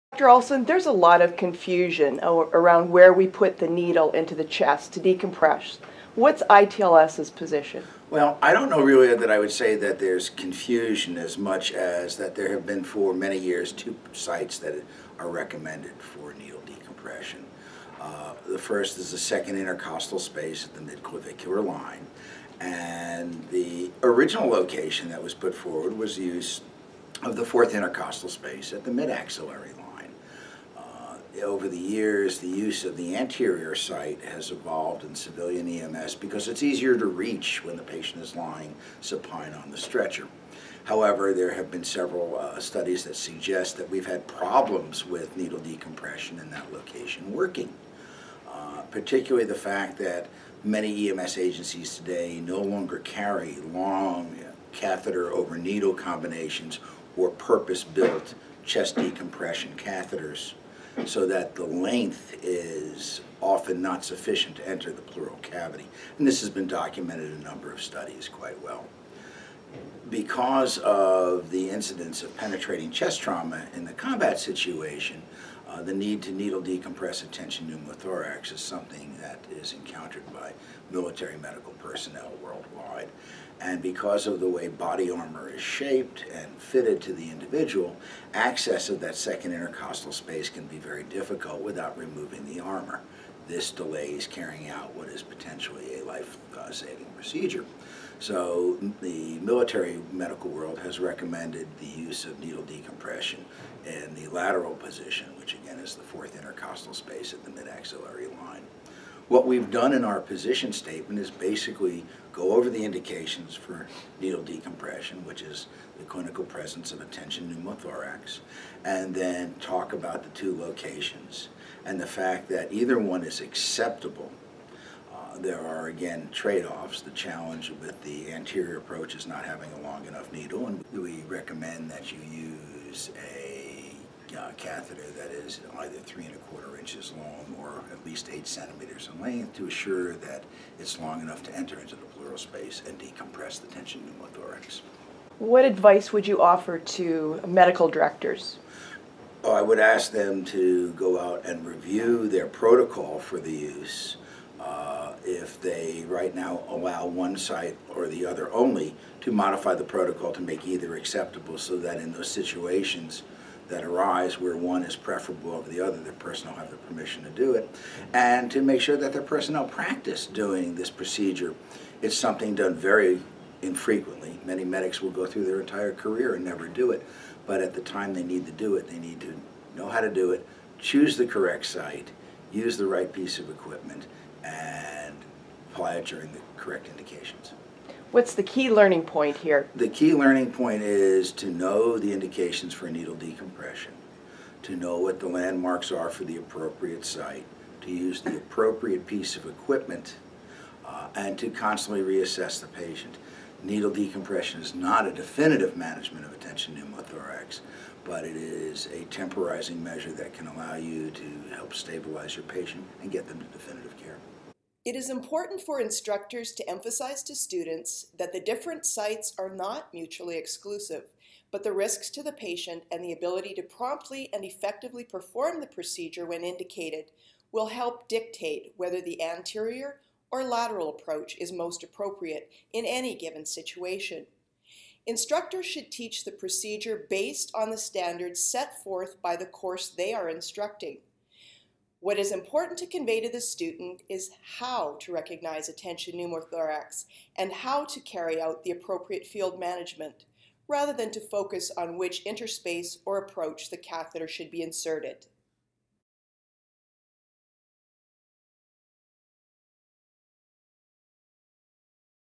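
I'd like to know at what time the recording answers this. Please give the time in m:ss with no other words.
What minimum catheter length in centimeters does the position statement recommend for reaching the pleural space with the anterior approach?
2:18.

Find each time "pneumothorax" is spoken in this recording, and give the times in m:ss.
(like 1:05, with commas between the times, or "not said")
1:17, 1:57, 2:24, 3:26, 4:06.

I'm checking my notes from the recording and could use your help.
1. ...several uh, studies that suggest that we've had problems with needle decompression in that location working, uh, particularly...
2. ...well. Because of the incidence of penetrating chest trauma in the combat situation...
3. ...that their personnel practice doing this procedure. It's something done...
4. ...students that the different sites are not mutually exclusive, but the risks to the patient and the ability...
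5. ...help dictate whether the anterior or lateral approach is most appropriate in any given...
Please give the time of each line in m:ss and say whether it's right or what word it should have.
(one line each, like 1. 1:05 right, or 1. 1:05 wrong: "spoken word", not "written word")
1. 0:41 right
2. 1:08 right
3. 2:48 right
4. 3:37 right
5. 3:47 right.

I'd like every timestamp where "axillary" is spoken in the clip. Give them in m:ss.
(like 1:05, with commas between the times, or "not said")
0:28, 1:47.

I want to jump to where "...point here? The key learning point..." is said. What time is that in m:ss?
3:09.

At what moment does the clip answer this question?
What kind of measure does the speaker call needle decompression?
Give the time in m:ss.
3:29.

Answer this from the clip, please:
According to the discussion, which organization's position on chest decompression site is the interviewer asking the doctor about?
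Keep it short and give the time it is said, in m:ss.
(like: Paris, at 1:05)
ITLS, at 0:06.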